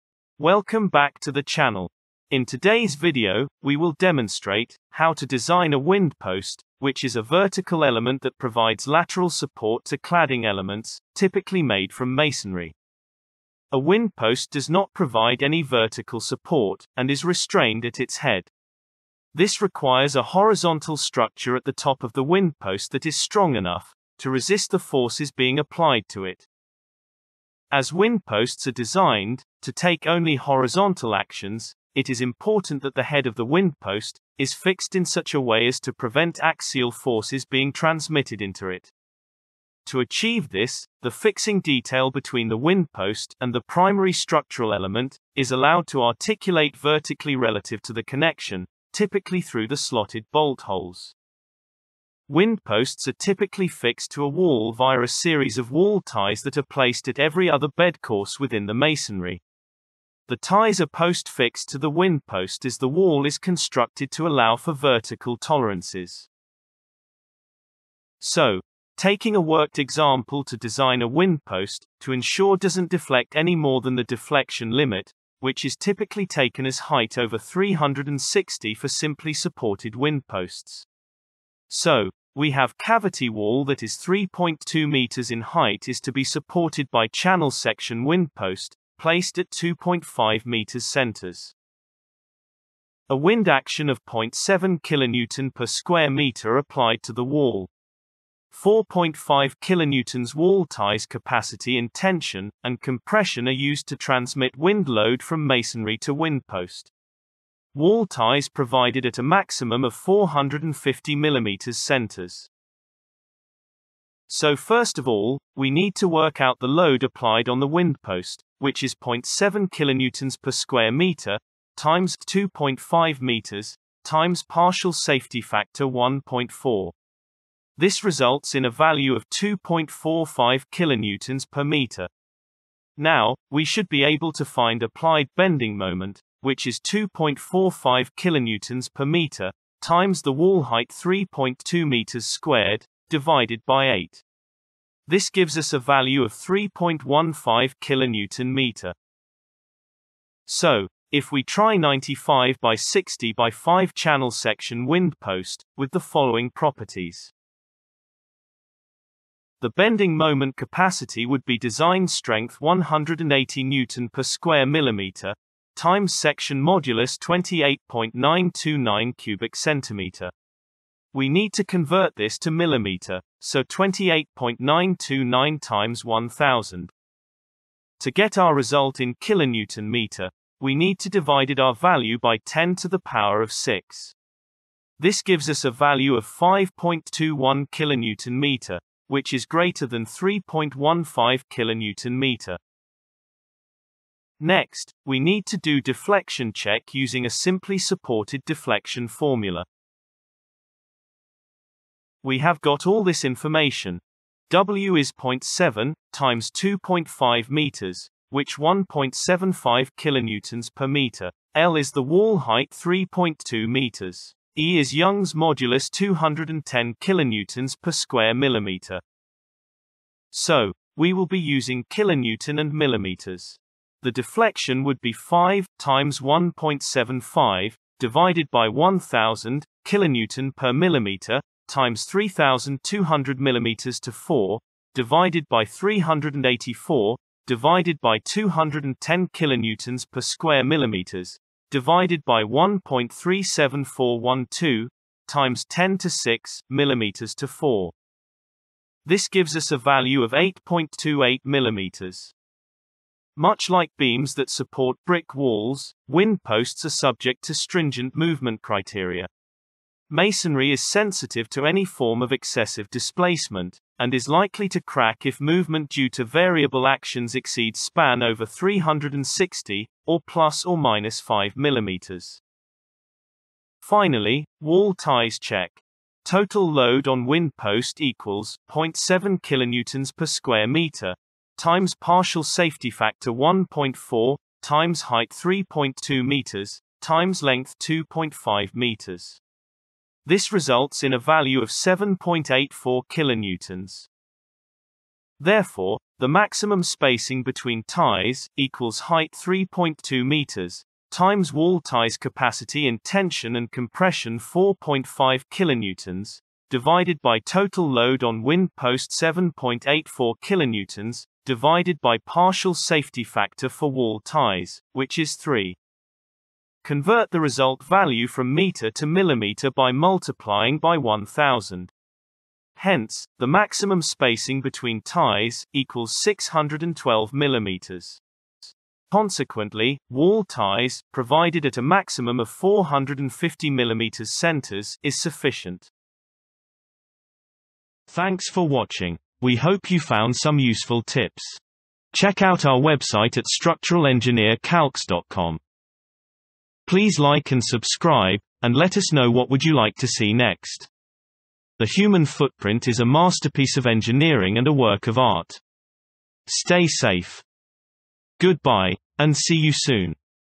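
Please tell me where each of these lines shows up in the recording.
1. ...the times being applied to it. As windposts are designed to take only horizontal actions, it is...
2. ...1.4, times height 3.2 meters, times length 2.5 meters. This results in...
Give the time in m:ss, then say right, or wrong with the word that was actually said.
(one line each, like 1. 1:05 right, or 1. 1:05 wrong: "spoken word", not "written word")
1. 0:24 wrong: "forces", not "times"
2. 4:43 right.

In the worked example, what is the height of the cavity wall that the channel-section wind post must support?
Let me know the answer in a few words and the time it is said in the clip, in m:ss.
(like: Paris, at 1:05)
3.2 meters, at 1:23.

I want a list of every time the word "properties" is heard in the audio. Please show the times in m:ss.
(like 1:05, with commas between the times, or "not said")
2:36.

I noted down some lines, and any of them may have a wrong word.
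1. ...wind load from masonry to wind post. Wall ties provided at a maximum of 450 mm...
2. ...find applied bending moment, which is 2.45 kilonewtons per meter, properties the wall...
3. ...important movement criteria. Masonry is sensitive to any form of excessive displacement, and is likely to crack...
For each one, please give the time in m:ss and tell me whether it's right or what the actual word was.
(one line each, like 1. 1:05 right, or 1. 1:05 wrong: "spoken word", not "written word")
1. 1:44 right
2. 2:14 wrong: "times", not "properties"
3. 4:17 wrong: "stringent", not "important".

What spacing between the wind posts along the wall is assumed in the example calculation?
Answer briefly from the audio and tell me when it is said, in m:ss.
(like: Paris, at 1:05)
2.5 meters, at 1:29.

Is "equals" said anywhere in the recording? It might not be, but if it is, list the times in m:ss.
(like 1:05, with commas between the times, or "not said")
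4:38, 4:58, 5:25.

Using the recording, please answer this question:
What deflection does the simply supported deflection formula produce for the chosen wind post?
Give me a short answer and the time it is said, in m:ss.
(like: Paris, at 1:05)
8.28 mm, at 4:10.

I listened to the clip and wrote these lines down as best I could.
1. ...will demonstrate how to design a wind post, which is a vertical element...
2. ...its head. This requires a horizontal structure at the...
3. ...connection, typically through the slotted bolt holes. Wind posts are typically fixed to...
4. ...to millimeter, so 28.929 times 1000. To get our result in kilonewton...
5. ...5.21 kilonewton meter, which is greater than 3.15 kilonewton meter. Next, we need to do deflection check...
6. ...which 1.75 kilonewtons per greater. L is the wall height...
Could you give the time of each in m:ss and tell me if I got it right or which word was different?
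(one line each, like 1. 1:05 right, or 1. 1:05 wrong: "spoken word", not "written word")
1. 0:03 right
2. 0:17 right
3. 0:48 right
4. 2:52 right
5. 3:06 right
6. 3:28 wrong: "meter", not "greater".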